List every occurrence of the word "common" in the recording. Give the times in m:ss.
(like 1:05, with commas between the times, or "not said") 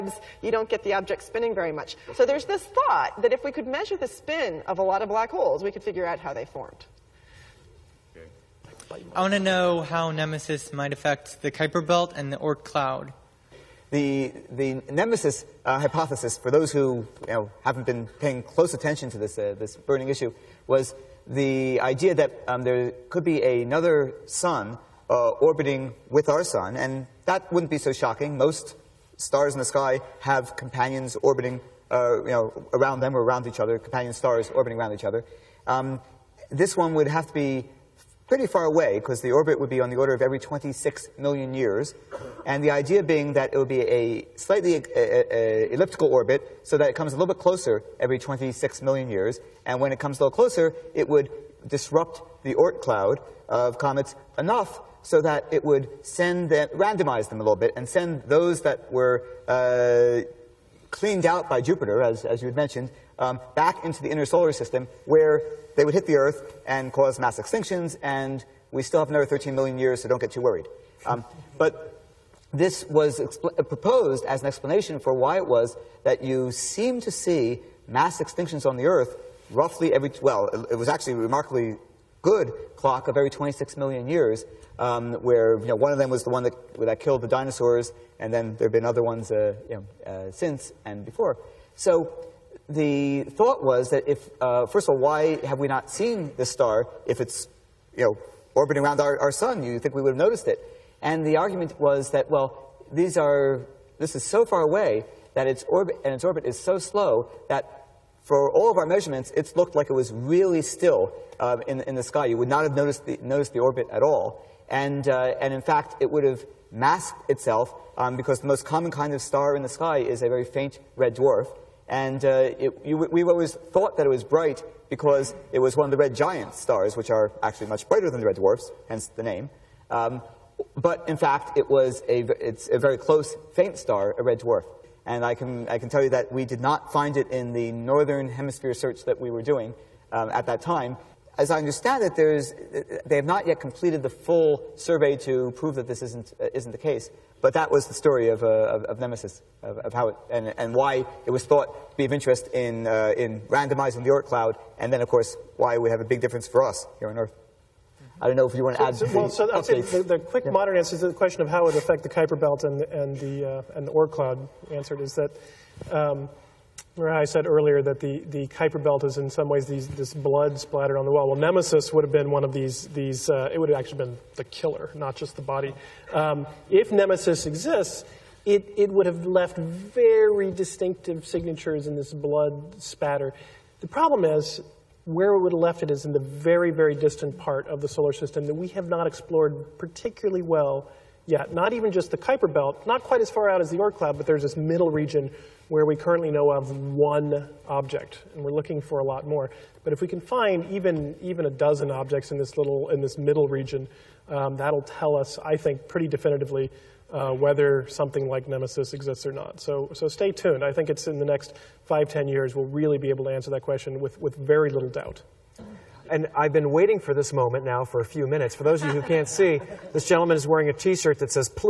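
1:58.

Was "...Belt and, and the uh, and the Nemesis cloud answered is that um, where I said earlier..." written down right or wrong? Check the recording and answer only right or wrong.
wrong.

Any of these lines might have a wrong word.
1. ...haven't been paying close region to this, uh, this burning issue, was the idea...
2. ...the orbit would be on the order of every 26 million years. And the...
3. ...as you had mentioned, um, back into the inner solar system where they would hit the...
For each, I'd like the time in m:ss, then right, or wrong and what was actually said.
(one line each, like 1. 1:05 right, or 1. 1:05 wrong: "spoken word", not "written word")
1. 0:17 wrong: "attention", not "region"
2. 0:39 right
3. 1:02 right.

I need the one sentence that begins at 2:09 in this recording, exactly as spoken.
Um, but in fact, it was a, it's a very close, faint star, a red dwarf.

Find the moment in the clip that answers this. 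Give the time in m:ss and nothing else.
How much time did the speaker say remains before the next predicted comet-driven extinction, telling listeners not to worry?
1:09.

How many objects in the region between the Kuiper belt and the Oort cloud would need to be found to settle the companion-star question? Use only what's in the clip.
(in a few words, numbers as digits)
a dozen.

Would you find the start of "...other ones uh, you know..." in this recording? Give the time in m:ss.
1:28.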